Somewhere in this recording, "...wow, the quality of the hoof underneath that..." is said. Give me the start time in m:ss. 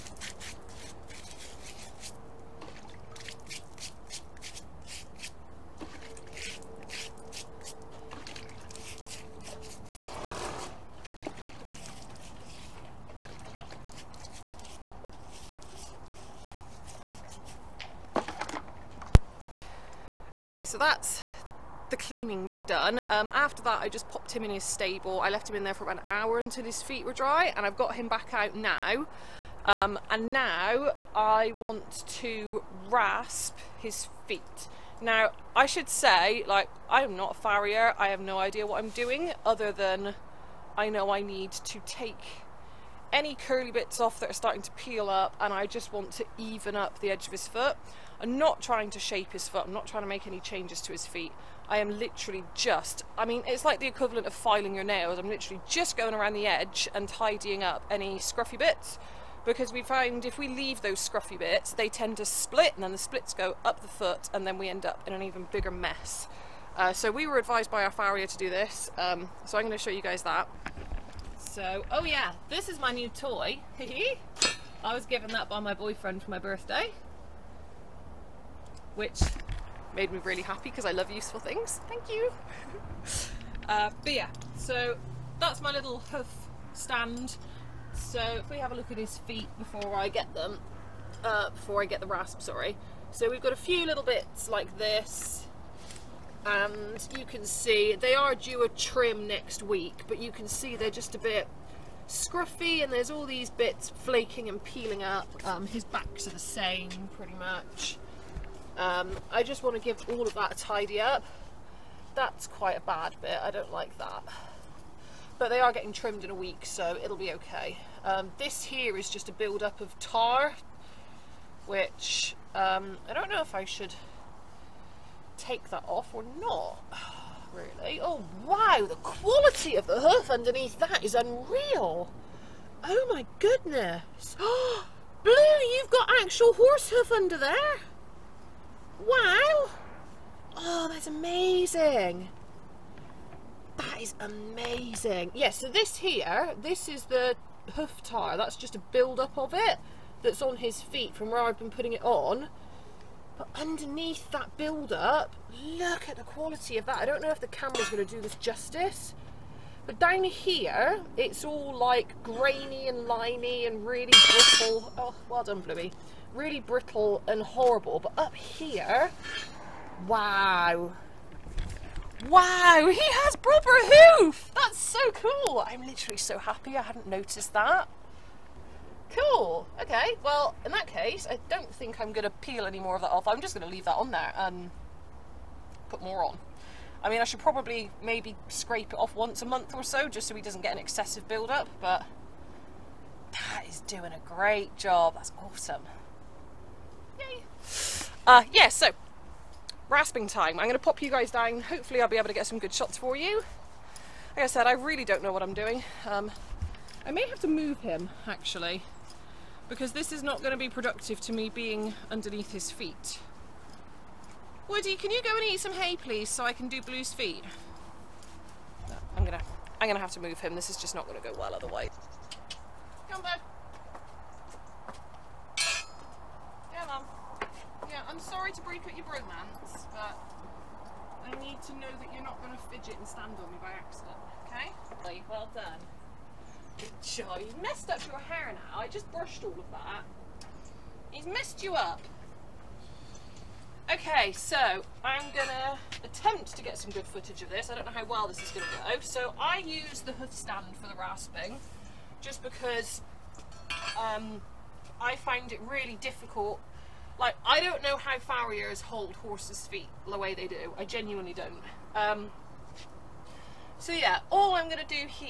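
2:08.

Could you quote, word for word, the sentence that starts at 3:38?
No, I'm gonna, I'm gonna have to move him.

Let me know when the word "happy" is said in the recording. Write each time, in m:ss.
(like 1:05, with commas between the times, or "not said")
1:20, 2:56.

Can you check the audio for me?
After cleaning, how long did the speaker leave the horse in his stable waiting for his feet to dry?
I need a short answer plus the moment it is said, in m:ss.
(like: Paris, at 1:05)
about an hour, at 0:25.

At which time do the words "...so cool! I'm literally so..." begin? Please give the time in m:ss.
2:54.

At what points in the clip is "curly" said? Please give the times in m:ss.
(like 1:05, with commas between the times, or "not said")
0:43.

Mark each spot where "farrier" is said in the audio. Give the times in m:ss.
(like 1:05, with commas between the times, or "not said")
0:37, 1:07, 4:18.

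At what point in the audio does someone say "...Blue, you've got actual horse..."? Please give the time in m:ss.
2:15.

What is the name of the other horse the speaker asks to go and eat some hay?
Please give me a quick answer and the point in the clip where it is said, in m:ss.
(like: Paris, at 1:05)
Woody, at 3:34.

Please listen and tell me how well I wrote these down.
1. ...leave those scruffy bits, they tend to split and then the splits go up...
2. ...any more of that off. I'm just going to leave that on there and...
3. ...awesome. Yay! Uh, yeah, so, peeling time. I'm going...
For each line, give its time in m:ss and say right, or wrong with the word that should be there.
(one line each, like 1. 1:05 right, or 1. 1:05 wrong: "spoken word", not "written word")
1. 1:00 right
2. 3:02 right
3. 3:15 wrong: "rasping", not "peeling".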